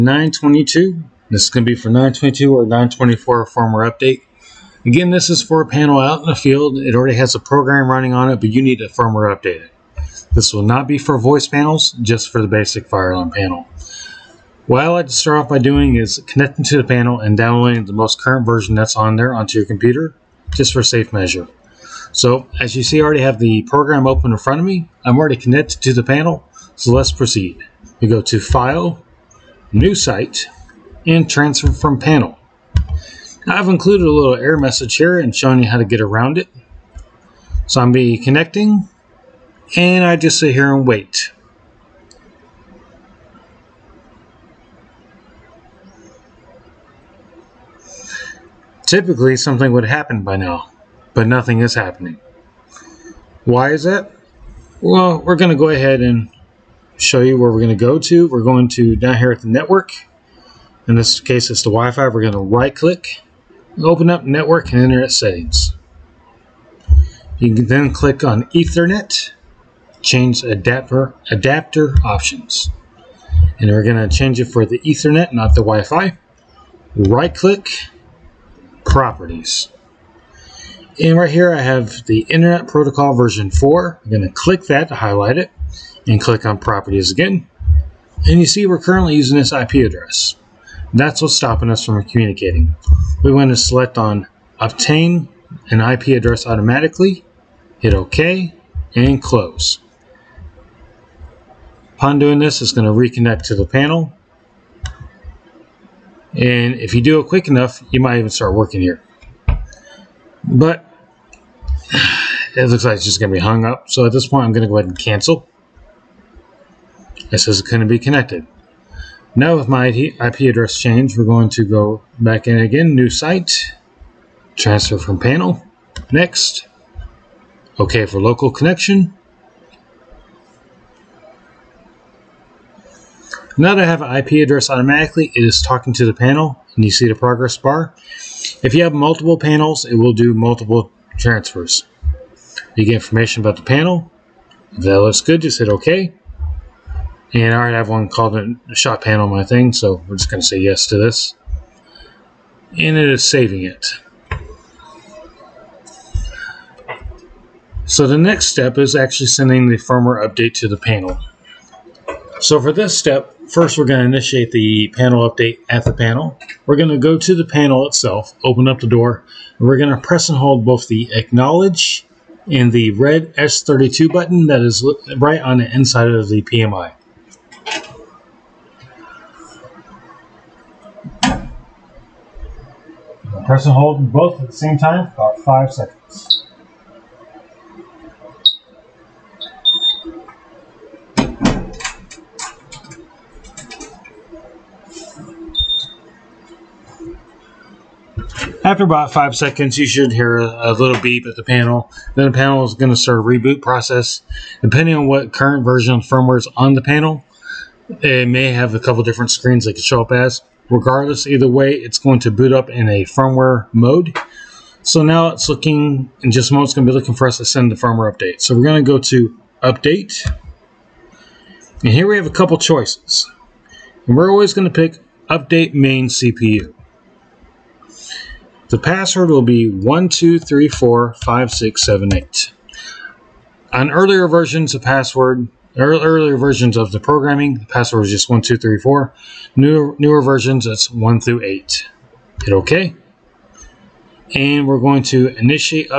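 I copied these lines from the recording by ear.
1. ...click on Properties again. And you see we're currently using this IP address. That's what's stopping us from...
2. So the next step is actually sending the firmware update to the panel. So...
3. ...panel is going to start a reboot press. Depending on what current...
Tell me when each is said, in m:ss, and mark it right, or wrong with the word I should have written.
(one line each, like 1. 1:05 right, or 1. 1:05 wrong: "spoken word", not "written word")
1. 1:26 right
2. 2:37 right
3. 3:22 wrong: "process", not "press".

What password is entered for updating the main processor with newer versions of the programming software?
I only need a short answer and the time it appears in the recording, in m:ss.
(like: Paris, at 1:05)
12345678, at 3:49.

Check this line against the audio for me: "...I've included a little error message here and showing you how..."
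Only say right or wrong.
right.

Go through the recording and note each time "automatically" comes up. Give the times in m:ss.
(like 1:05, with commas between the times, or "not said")
1:36, 2:14.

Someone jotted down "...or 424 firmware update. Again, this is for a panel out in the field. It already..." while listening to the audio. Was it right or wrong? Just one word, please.
wrong.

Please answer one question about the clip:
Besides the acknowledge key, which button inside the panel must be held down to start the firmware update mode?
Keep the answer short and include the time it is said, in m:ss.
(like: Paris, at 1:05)
red S32 button, at 2:52.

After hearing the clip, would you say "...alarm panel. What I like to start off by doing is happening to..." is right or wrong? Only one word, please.
wrong.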